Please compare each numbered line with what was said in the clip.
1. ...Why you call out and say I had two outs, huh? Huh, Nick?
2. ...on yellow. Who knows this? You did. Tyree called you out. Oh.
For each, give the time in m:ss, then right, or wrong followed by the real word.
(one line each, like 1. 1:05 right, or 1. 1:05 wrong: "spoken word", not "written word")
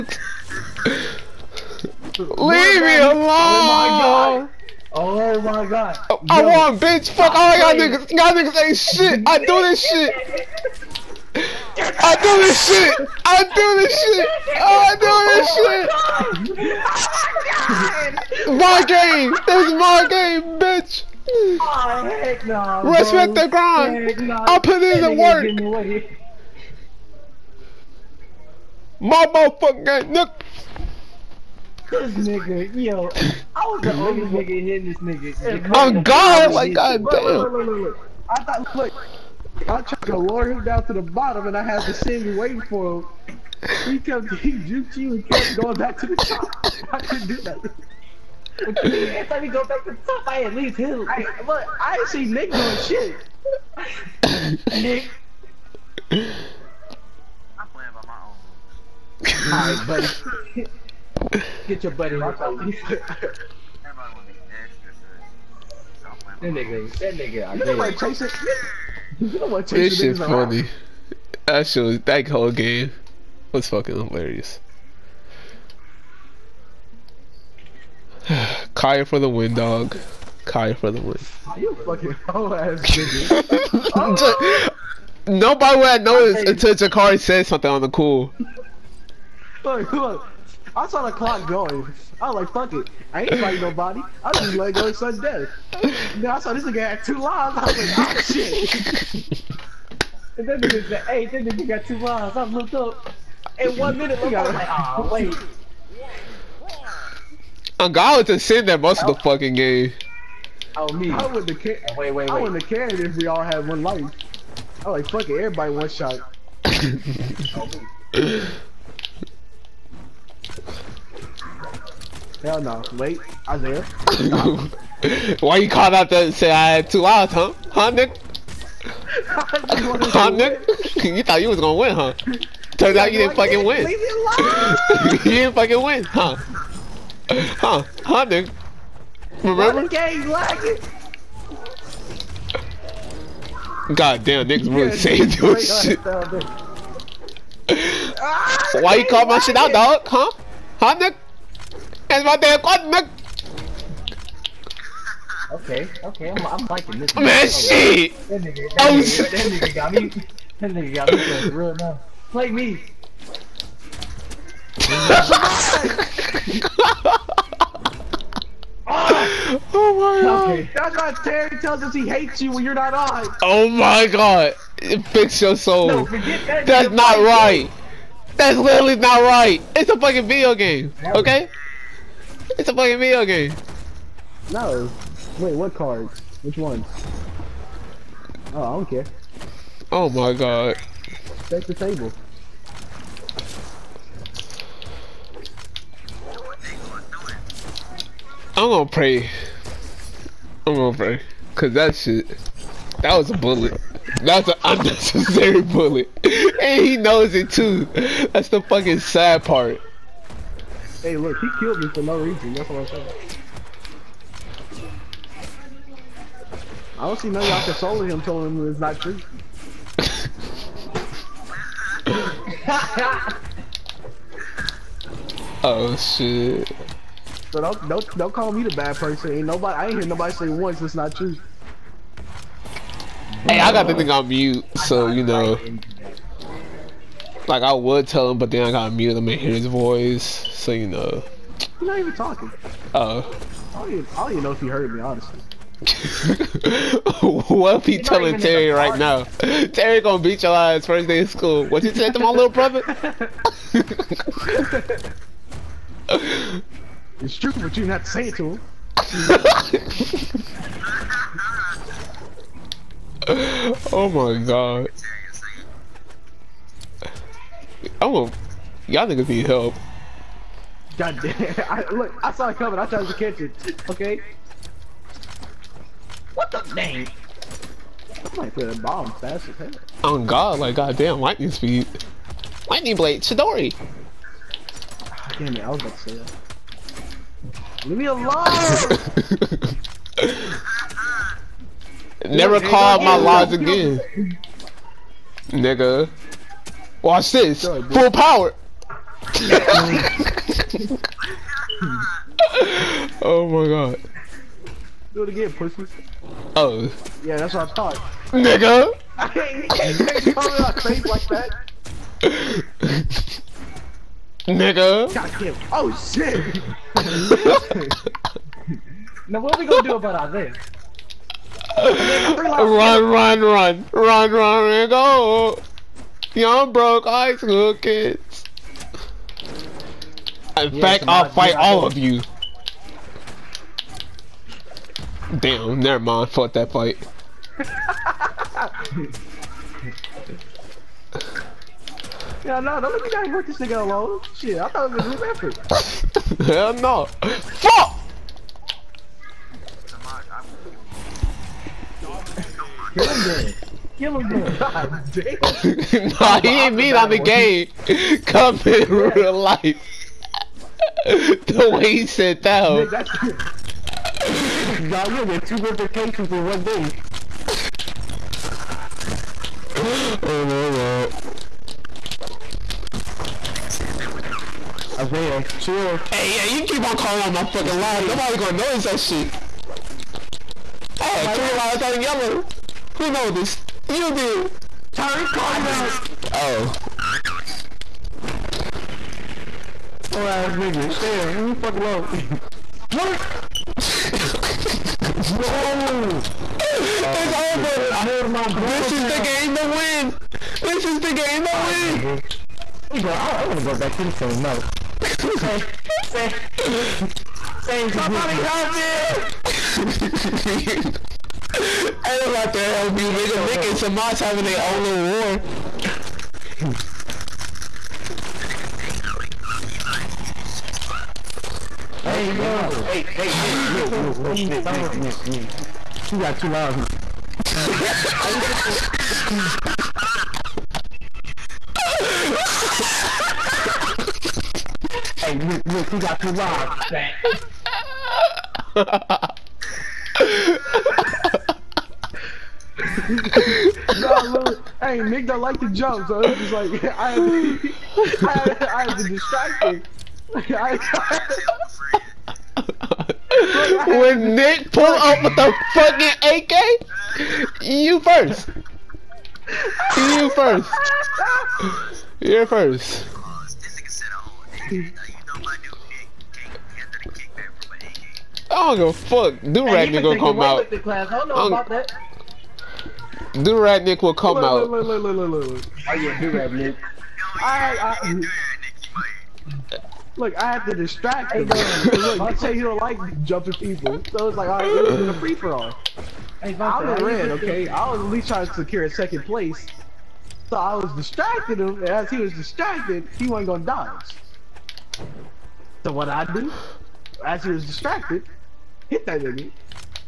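1. 2:05 right
2. 6:21 right.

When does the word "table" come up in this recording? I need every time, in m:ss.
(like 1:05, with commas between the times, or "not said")
3:11.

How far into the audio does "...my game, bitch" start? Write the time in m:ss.
0:19.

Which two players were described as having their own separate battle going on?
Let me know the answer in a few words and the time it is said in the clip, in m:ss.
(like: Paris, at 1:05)
Nick and Samaj, at 6:53.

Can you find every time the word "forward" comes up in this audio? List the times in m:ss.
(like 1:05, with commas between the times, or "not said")
not said.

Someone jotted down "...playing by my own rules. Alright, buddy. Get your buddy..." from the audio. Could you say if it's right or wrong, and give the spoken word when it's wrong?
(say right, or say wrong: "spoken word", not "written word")
right.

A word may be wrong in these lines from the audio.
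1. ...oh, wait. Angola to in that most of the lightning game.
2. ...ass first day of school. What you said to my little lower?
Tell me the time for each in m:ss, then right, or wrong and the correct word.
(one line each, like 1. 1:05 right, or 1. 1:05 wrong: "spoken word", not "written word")
1. 1:45 wrong: "fucking", not "lightning"
2. 4:10 wrong: "brother", not "lower".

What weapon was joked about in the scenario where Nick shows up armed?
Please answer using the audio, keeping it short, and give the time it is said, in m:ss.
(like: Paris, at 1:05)
AK, at 7:36.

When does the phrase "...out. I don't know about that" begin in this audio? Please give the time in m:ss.
7:50.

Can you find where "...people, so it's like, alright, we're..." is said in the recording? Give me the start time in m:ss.
8:03.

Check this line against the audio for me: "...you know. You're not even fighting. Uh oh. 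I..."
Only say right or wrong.
wrong.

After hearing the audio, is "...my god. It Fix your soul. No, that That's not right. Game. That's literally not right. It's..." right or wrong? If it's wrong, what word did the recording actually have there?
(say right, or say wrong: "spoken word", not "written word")
right.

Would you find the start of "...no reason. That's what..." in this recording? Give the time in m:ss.
3:32.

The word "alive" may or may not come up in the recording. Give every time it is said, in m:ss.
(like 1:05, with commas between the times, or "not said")
not said.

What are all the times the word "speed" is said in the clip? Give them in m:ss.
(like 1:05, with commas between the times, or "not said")
4:41.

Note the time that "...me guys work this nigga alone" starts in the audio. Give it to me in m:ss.
5:43.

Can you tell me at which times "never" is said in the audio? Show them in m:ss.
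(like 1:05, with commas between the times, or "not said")
4:52, 5:35.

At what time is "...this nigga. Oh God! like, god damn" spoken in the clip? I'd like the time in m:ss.
0:34.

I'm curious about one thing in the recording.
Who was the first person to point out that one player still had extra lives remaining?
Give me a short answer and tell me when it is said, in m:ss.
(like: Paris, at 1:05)
Jakari, at 1:26.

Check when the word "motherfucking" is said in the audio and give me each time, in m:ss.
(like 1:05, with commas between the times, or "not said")
0:29.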